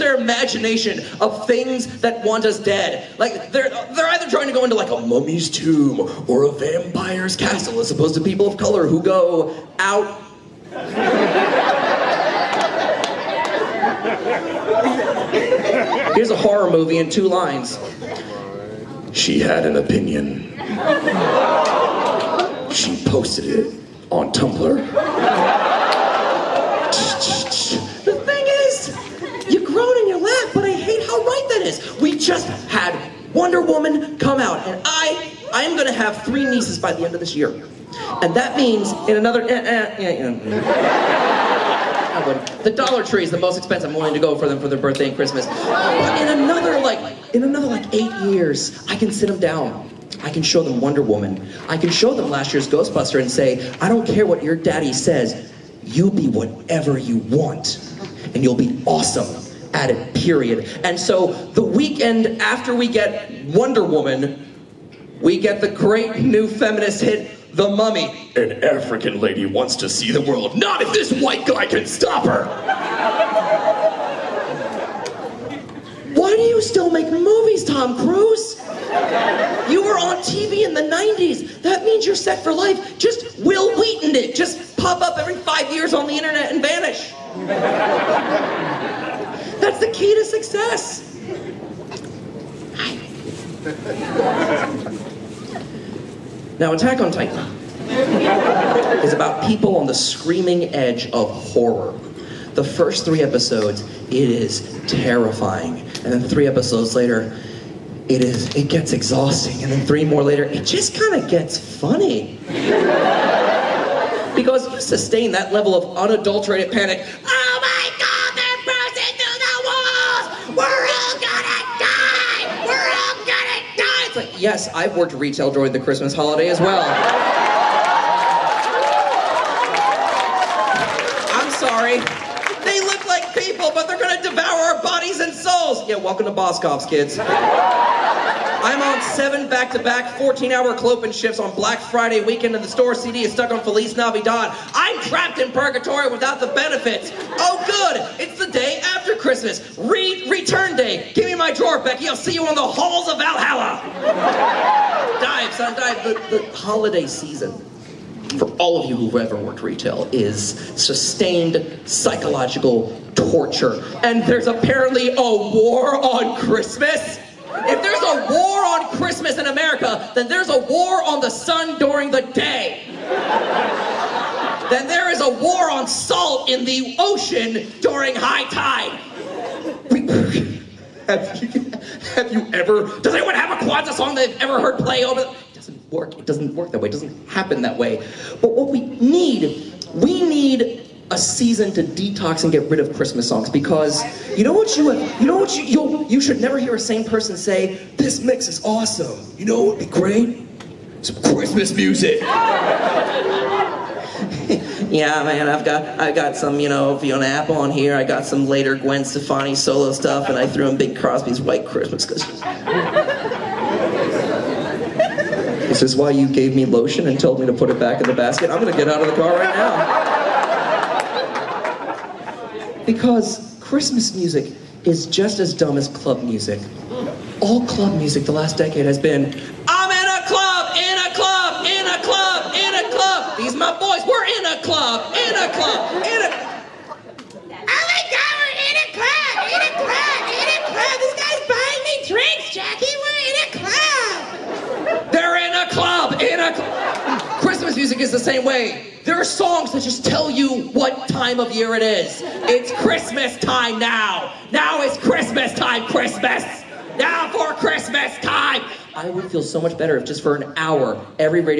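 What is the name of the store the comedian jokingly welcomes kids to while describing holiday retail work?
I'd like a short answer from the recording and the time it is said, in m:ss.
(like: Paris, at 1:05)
Boscov's, at 2:16.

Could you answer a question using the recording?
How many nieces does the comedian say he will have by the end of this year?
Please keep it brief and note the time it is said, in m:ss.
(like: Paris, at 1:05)
3, at 0:36.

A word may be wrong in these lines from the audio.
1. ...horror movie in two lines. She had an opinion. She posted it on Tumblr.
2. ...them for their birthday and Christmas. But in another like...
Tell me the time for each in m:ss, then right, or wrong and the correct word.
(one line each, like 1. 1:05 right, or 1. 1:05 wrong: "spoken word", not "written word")
1. 0:16 right
2. 0:44 right.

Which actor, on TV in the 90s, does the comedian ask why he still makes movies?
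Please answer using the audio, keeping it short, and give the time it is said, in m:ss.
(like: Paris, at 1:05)
Tom Cruise, at 1:17.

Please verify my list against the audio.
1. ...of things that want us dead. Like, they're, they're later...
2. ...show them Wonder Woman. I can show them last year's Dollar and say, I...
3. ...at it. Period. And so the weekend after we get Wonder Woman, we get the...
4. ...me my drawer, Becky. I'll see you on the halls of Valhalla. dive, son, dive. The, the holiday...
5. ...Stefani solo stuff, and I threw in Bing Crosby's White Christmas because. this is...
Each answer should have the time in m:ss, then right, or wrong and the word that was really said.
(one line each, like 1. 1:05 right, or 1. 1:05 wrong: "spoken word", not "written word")
1. 0:01 wrong: "either", not "later"
2. 0:50 wrong: "Ghostbuster", not "Dollar"
3. 0:59 right
4. 2:31 right
5. 3:29 right.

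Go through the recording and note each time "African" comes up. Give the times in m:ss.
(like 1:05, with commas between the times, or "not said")
1:08.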